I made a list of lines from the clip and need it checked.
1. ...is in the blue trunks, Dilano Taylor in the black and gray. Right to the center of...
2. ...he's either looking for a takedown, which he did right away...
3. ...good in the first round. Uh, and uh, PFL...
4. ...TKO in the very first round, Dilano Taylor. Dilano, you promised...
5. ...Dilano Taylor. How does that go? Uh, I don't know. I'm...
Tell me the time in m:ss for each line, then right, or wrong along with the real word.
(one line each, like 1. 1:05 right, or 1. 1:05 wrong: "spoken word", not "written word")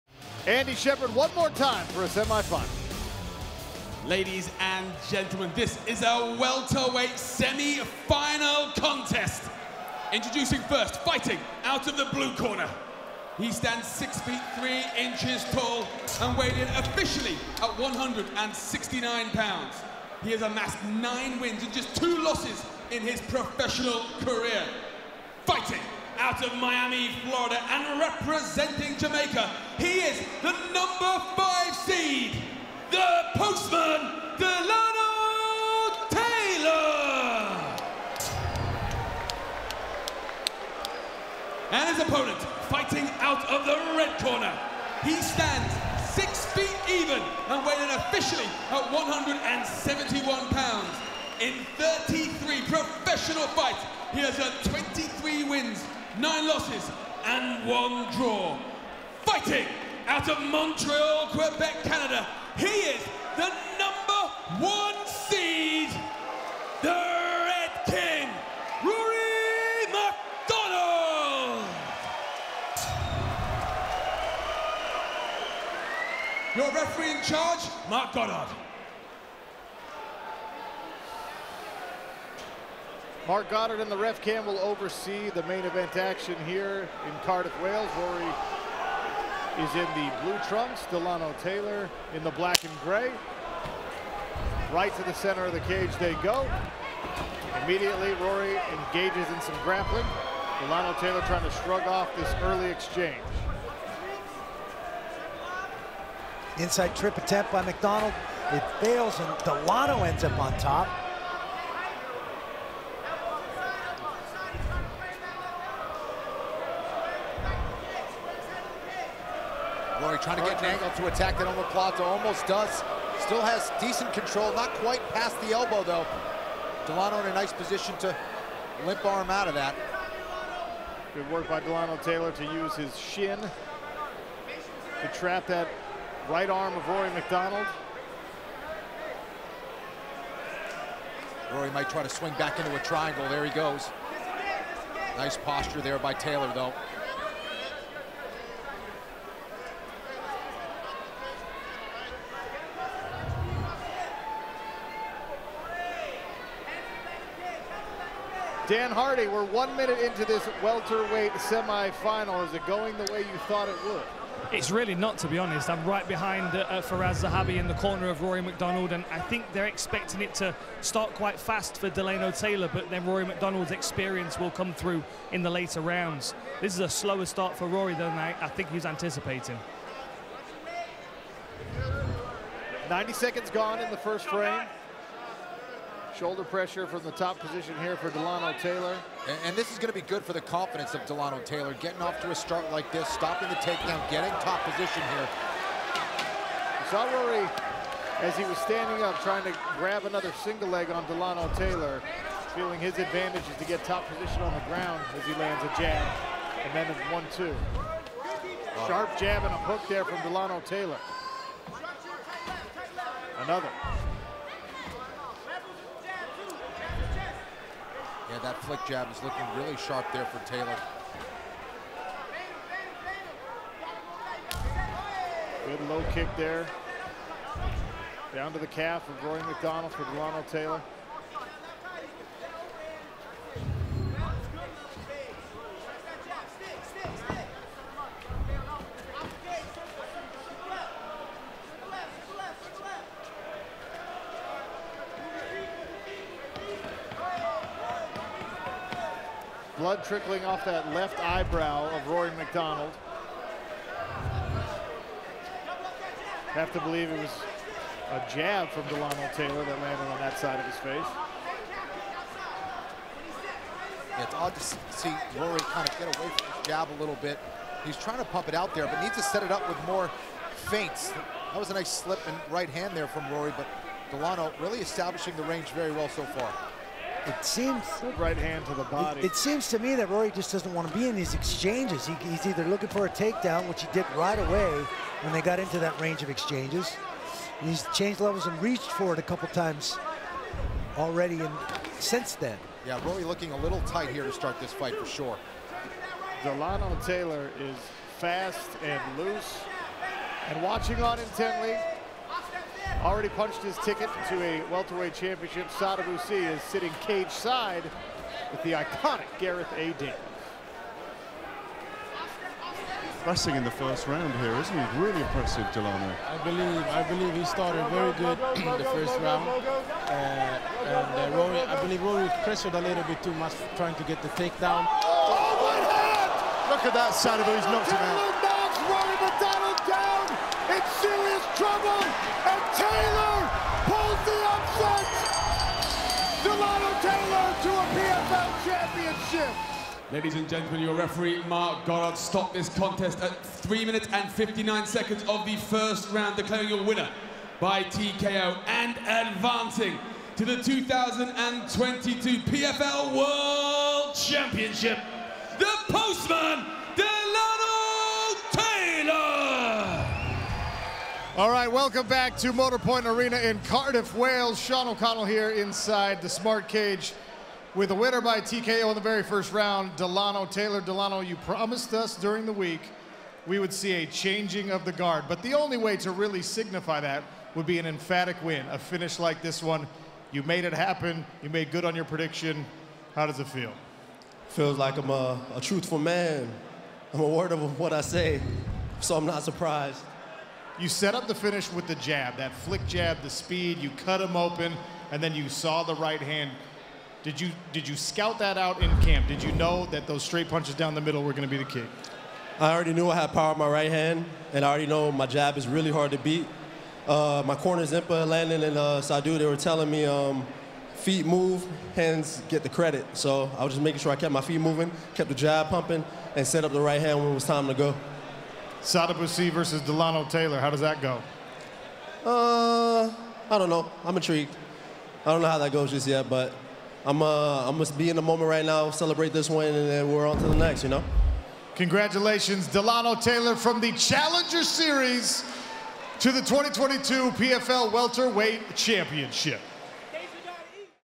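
1. 1:29 right
2. 4:42 right
3. 5:18 wrong: "Rory", not "PFL"
4. 6:08 right
5. 6:59 right.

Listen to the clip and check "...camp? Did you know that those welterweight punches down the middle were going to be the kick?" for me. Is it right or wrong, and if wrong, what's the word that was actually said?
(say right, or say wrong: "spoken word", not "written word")
wrong: "straight", not "welterweight".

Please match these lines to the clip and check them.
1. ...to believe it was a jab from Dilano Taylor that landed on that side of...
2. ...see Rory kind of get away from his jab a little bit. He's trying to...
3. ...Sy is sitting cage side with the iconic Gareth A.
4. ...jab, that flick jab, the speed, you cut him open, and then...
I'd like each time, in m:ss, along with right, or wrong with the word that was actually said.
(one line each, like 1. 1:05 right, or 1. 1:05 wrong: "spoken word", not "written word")
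1. 4:16 right
2. 4:24 right
3. 5:06 right
4. 6:31 right.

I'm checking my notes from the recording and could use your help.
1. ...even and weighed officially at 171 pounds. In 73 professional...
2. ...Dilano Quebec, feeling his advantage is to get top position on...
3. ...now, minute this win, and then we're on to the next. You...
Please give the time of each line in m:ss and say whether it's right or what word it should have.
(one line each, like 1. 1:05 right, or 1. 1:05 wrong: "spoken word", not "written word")
1. 0:46 wrong: "33", not "73"
2. 3:21 wrong: "Taylor", not "Quebec"
3. 7:08 wrong: "celebrate", not "minute".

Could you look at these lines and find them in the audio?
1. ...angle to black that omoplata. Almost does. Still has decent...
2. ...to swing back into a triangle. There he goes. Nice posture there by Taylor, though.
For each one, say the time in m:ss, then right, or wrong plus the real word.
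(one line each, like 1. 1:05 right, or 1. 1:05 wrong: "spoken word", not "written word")
1. 2:00 wrong: "attack", not "black"
2. 2:22 right.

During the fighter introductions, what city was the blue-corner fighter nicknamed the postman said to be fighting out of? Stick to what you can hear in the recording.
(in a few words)
Miami, Florida.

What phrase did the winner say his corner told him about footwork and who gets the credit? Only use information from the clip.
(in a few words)
Feet move, hands get the credit.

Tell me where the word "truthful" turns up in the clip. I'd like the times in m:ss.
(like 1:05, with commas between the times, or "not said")
6:25.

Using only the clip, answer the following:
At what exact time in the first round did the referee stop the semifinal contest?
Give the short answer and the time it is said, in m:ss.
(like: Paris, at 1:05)
3:59, at 5:43.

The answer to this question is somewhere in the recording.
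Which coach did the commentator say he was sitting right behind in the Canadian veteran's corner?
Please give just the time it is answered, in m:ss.
2:46.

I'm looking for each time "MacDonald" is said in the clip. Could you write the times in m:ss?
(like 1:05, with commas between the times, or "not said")
1:09, 1:47, 2:17, 2:48, 2:53, 3:49, 4:12.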